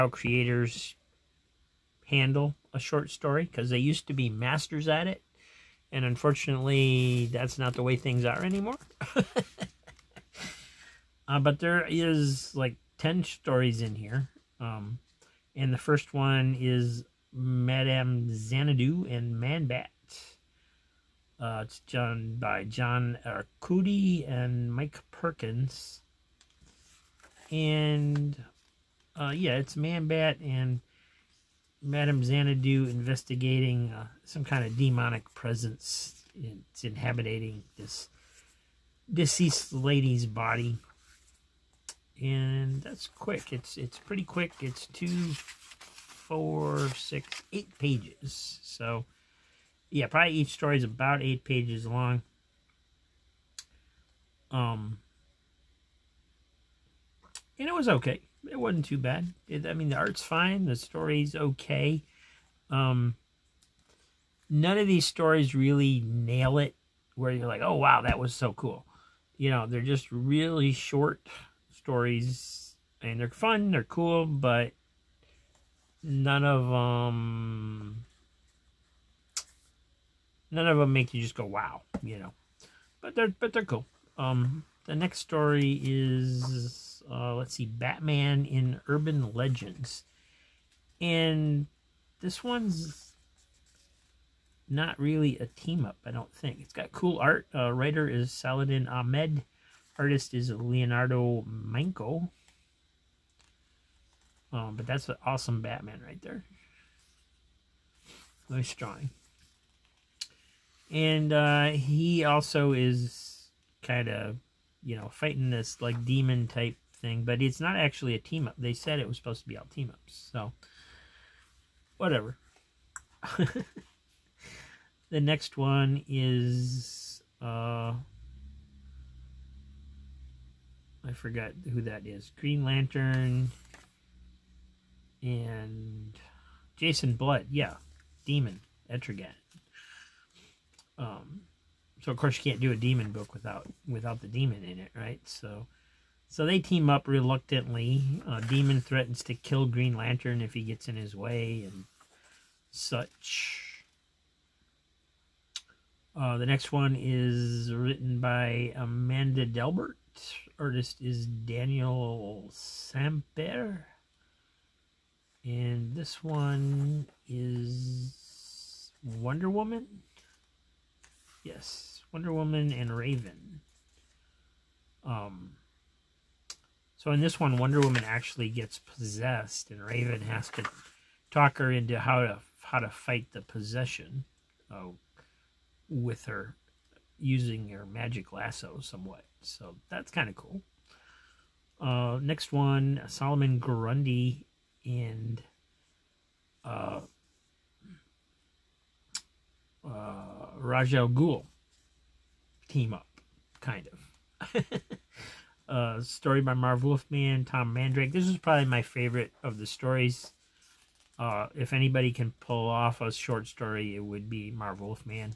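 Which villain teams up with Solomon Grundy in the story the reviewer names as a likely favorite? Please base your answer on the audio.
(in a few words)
Ra's al Ghul.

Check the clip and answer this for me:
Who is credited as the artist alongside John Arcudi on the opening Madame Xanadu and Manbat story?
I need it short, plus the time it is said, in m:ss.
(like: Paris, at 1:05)
Mike Perkins, at 0:24.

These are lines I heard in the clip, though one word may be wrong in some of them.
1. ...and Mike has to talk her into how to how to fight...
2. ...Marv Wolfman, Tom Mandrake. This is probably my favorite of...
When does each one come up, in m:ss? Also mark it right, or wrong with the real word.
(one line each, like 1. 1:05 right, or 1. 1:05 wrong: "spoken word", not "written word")
1. 2:59 wrong: "Raven", not "Mike"
2. 3:26 right.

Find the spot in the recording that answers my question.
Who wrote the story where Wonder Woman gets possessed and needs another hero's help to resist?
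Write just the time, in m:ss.
2:38.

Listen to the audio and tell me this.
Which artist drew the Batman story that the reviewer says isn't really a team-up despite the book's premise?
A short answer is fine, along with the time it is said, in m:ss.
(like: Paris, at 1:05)
Leonardo Manco, at 1:40.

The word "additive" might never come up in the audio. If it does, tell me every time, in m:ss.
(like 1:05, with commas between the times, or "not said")
not said.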